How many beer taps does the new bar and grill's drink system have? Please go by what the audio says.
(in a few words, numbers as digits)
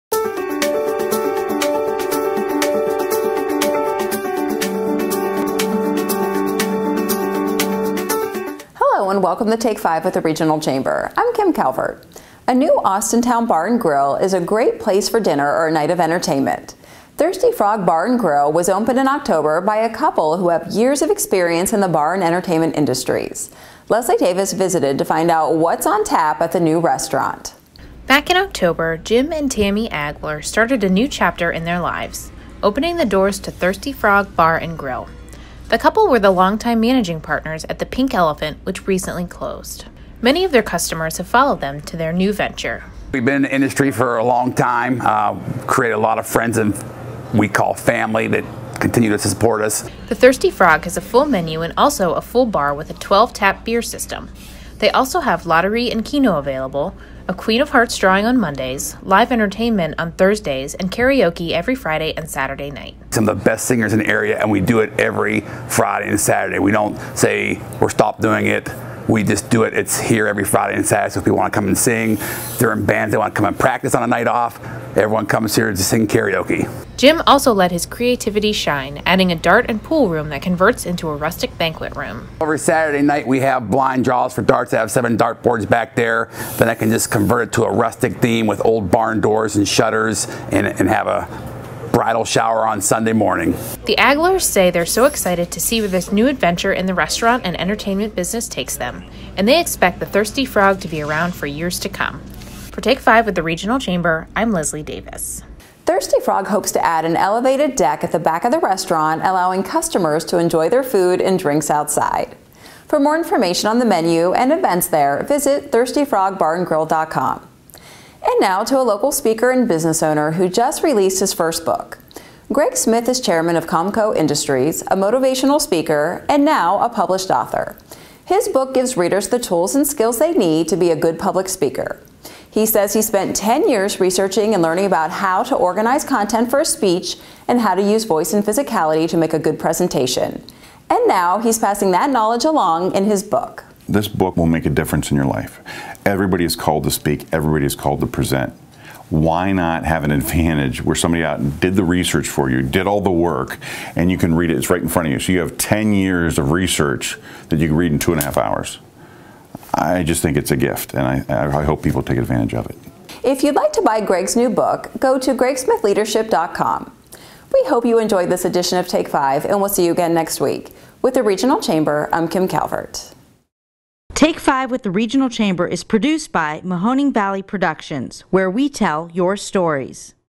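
12.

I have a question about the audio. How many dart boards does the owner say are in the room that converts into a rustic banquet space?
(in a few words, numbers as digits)
7.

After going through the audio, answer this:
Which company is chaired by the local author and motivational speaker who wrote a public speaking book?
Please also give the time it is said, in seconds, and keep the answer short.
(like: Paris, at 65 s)
Comco Industries, at 123 s.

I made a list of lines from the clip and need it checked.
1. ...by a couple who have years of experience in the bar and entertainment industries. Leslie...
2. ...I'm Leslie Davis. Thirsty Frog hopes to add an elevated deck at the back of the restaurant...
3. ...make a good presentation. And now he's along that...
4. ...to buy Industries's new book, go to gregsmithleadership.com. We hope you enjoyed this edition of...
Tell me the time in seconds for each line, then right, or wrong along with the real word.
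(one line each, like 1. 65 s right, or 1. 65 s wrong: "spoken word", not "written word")
1. 19 s right
2. 104 s right
3. 139 s wrong: "passing", not "along"
4. 163 s wrong: "Greg", not "Industries".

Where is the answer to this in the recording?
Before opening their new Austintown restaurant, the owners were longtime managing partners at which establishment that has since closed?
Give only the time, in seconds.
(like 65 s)
37 s.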